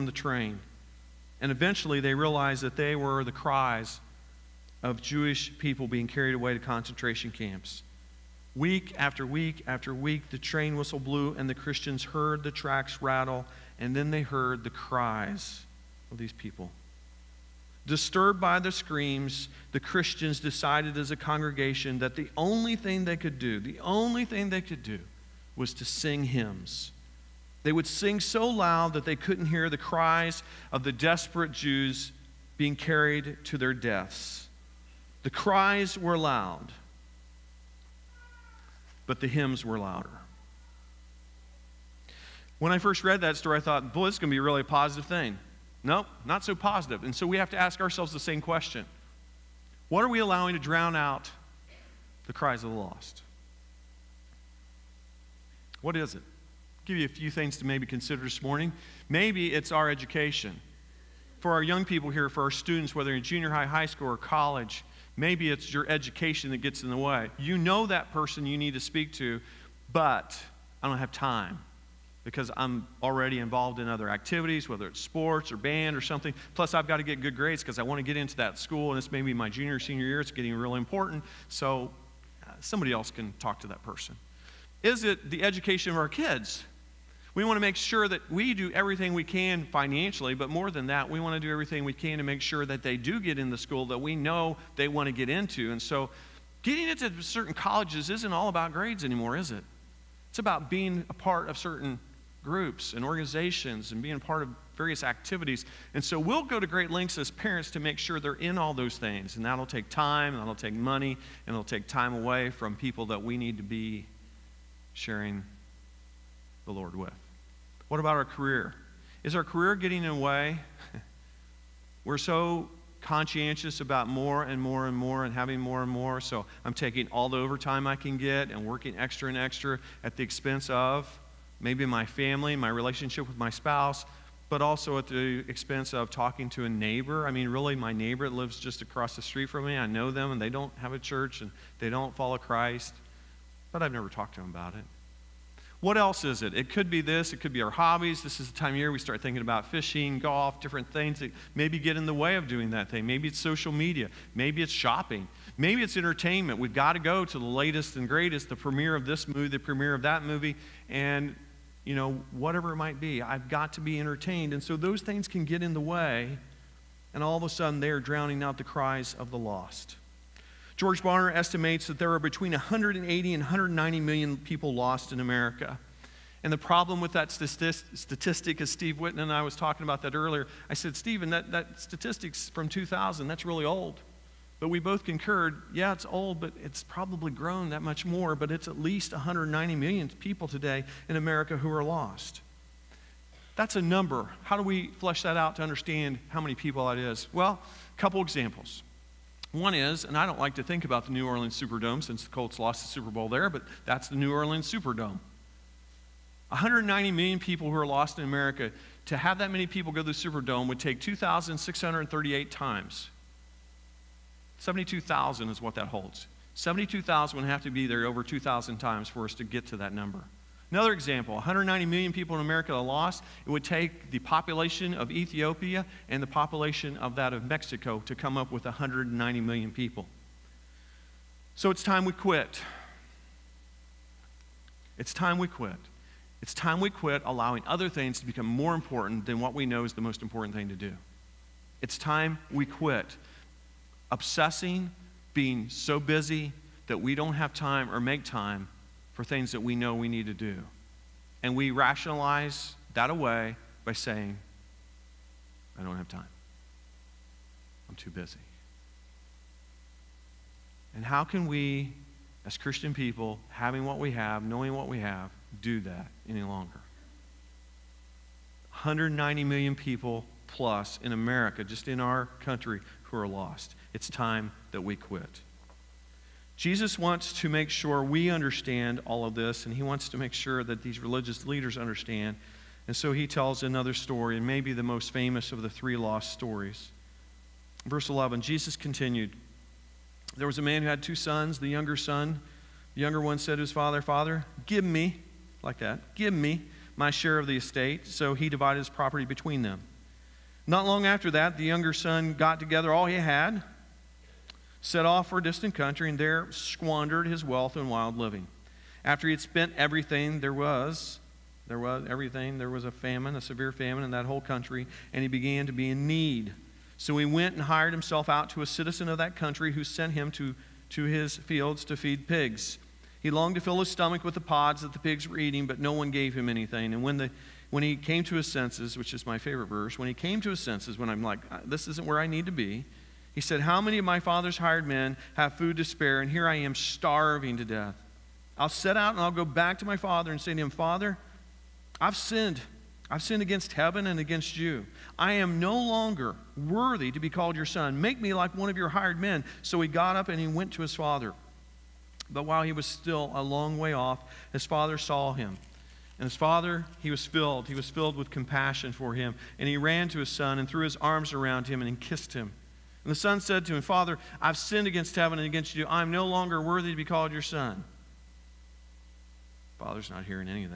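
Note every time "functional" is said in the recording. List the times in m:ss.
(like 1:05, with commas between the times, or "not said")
not said.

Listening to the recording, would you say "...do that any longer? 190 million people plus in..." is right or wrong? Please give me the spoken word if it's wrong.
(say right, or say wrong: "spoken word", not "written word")
right.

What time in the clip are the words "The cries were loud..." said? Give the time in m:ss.
0:35.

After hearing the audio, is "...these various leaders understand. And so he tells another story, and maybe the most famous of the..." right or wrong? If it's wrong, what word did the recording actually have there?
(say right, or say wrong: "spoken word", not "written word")
wrong: "religious", not "various".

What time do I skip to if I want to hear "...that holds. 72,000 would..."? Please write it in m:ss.
3:35.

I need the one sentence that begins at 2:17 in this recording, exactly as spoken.
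I mean, really, my neighbor lives just across the street from me.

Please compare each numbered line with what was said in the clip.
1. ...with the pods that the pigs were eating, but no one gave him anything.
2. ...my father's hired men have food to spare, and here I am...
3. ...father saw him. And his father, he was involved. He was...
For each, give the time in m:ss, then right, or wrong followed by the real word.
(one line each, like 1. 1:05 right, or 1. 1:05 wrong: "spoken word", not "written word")
1. 5:24 right
2. 5:34 right
3. 5:54 wrong: "filled", not "involved".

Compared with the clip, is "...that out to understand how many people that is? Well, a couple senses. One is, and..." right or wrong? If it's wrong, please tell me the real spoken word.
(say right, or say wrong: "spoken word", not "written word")
wrong: "examples", not "senses".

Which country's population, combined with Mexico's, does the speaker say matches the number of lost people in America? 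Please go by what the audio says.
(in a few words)
Ethiopia.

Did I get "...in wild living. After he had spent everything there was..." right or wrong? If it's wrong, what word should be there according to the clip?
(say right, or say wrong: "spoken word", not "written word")
right.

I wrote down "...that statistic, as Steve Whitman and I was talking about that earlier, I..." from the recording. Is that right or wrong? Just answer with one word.
right.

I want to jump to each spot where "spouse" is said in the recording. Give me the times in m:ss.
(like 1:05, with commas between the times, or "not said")
2:13.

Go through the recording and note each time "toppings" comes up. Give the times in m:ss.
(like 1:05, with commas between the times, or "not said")
not said.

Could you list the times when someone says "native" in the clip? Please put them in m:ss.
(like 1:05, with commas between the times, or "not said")
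not said.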